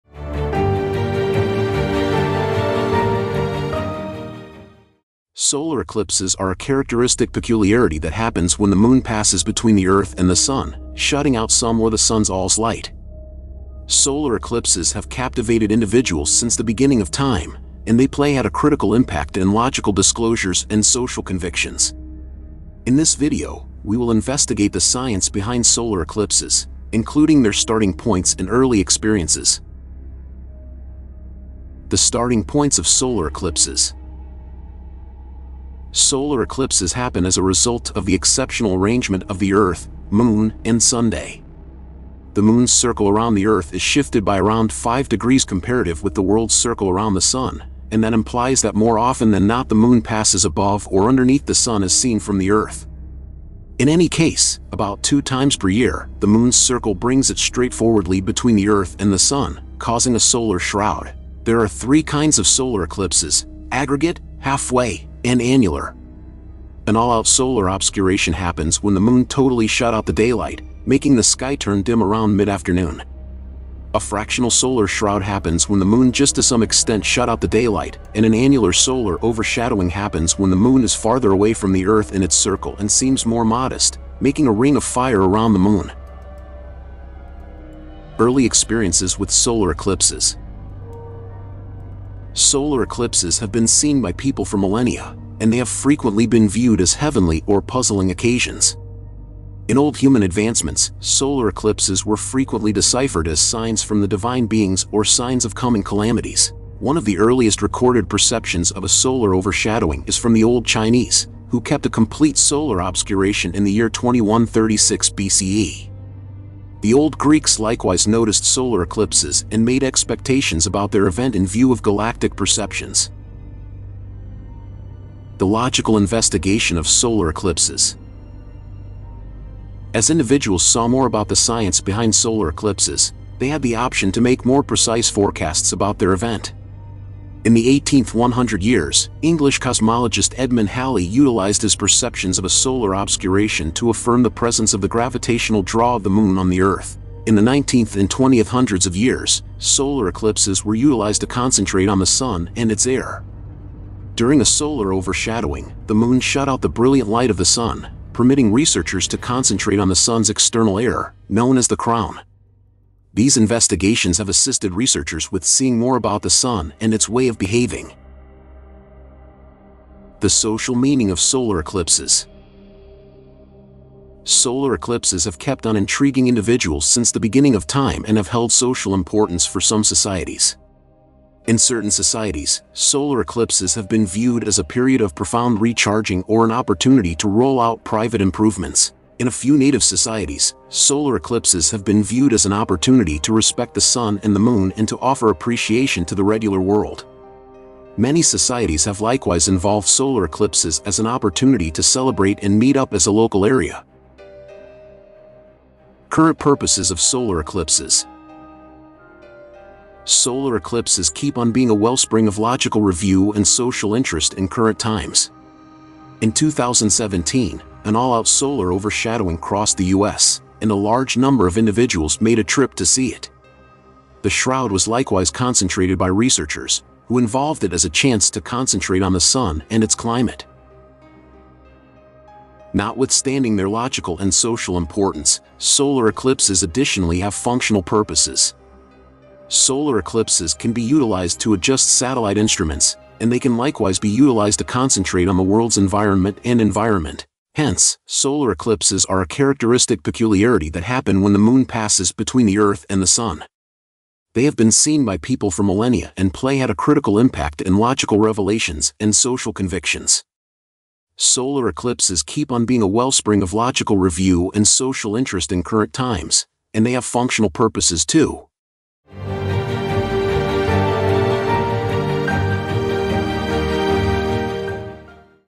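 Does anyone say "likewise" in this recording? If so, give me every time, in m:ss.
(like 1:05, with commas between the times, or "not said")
1:57, 3:18, 3:44, 4:03.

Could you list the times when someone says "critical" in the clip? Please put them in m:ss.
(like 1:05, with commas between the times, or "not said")
0:18, 4:16.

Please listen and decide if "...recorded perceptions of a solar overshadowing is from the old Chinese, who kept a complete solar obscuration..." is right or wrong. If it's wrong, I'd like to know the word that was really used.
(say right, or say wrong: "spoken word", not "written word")
right.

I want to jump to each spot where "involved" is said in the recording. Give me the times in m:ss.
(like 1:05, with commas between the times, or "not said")
3:19, 3:47.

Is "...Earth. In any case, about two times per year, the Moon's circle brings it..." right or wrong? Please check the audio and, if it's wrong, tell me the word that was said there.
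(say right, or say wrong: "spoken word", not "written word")
right.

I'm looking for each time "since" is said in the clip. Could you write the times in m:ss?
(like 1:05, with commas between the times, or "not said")
0:16, 2:56.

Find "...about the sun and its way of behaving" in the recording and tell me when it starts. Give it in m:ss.
2:45.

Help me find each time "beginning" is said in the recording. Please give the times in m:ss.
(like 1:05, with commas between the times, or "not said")
0:16, 2:57.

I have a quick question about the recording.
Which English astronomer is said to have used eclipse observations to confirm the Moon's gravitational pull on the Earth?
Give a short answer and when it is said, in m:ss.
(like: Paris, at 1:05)
Edmund Halley, at 2:20.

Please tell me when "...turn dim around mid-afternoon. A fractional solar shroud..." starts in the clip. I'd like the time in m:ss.
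1:11.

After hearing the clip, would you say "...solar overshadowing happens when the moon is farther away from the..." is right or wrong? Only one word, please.
right.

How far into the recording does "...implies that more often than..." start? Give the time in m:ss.
0:48.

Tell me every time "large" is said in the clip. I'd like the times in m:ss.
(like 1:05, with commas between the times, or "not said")
3:40.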